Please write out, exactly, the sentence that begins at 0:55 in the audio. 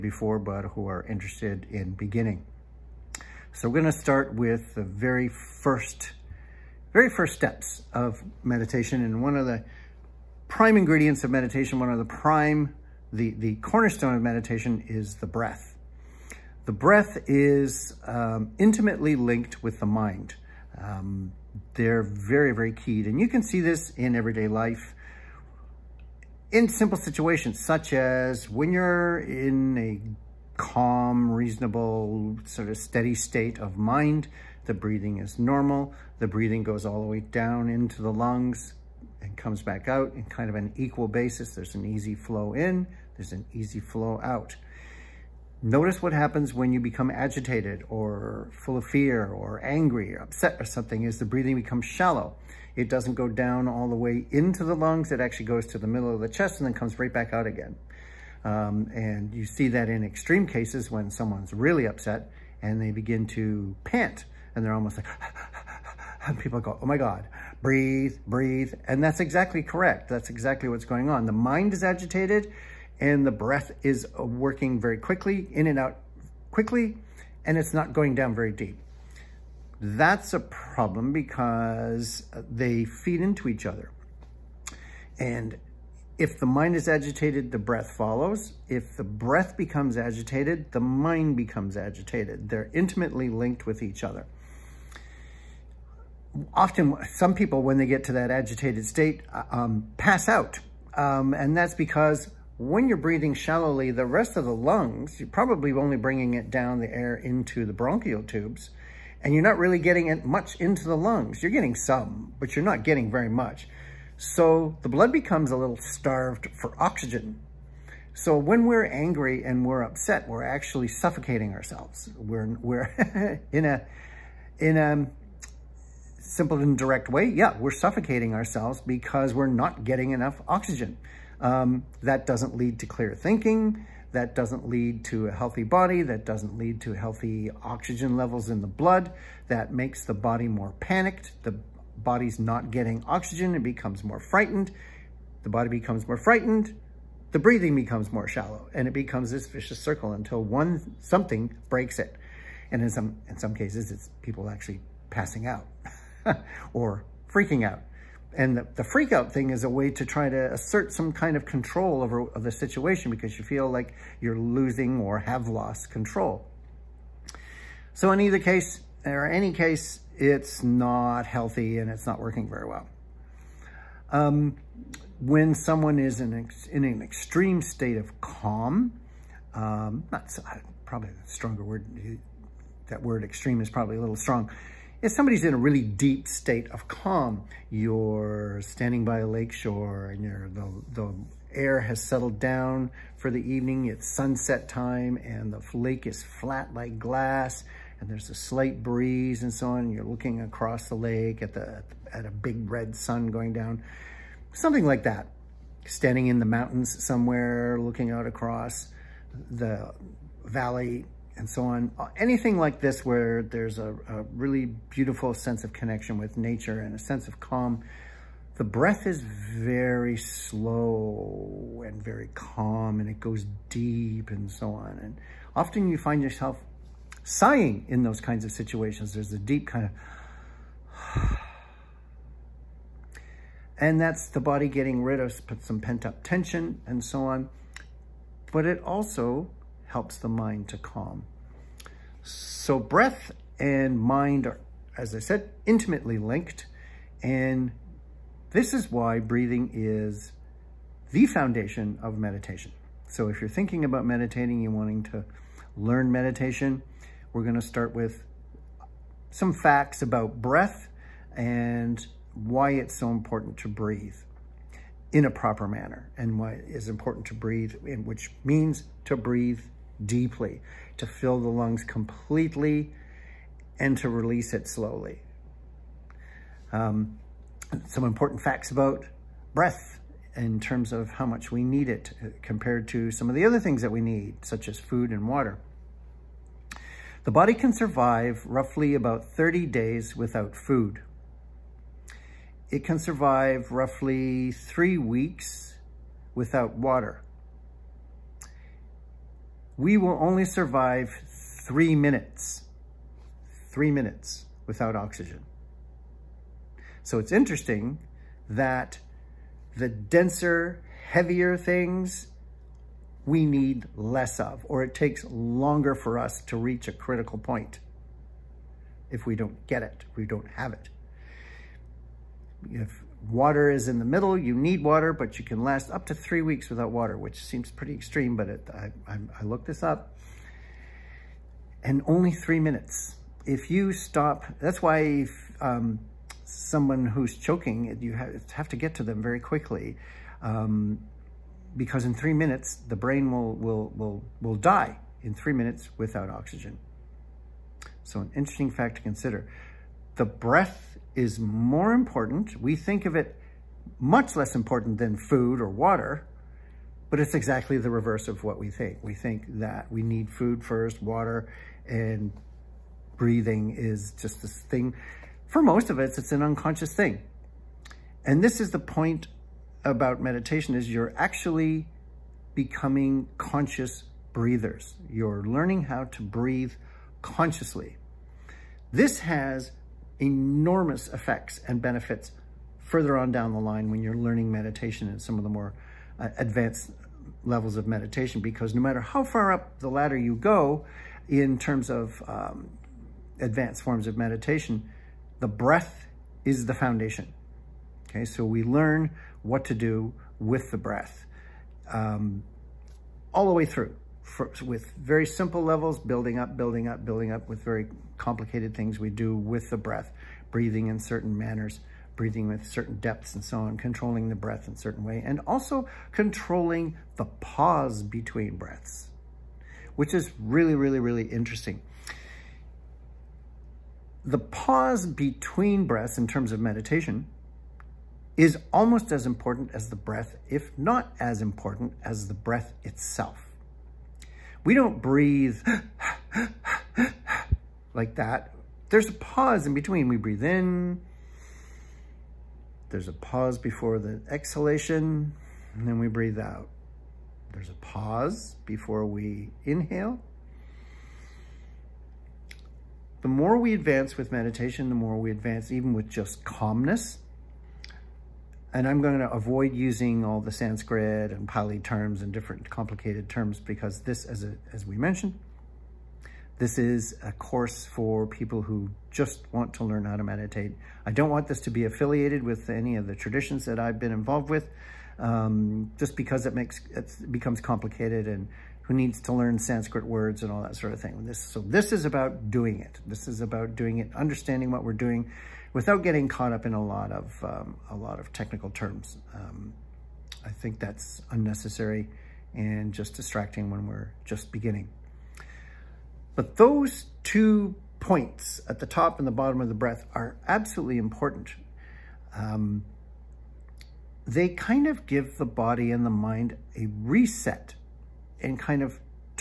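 It actually goes to the middle of the chest and then comes right back out again.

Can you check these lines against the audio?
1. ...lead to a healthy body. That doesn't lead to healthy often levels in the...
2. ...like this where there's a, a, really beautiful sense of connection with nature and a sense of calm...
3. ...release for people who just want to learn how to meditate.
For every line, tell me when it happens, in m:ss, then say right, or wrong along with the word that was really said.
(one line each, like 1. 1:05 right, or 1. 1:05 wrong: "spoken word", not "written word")
1. 2:14 wrong: "oxygen", not "often"
2. 3:32 right
3. 7:47 wrong: "course", not "release".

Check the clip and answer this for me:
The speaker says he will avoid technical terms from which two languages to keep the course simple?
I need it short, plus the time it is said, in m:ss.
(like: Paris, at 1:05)
Sanskrit and Pali, at 7:40.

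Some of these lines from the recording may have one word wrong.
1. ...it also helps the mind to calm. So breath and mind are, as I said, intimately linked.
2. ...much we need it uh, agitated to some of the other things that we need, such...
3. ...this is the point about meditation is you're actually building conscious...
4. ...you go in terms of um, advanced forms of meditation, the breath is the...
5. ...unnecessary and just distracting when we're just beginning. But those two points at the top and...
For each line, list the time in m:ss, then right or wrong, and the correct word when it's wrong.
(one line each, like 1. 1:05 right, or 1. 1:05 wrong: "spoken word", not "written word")
1. 3:58 right
2. 4:41 wrong: "compared", not "agitated"
3. 6:08 wrong: "becoming", not "building"
4. 6:30 right
5. 8:11 right.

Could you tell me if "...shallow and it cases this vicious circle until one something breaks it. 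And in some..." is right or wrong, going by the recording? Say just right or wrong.
wrong.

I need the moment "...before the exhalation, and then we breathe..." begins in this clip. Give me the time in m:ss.
7:23.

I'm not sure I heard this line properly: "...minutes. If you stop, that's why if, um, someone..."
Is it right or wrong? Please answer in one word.
right.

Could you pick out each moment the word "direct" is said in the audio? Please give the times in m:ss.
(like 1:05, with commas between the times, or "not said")
2:06.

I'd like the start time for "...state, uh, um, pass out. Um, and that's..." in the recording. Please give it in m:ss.
1:38.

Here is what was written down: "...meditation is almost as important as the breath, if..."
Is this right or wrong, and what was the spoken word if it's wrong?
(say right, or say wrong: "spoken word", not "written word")
right.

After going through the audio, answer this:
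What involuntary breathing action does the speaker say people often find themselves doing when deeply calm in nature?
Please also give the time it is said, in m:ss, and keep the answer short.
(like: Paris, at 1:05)
sighing, at 3:47.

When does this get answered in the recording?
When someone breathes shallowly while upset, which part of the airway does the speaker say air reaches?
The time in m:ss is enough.
1:47.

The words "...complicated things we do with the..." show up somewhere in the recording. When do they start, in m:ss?
6:48.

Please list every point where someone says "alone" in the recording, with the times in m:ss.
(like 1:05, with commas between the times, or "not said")
not said.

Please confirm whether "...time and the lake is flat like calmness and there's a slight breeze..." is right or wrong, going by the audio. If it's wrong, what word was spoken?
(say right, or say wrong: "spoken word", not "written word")
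wrong: "glass", not "calmness".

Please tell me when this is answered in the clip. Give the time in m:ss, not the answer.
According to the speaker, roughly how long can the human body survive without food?
4:49.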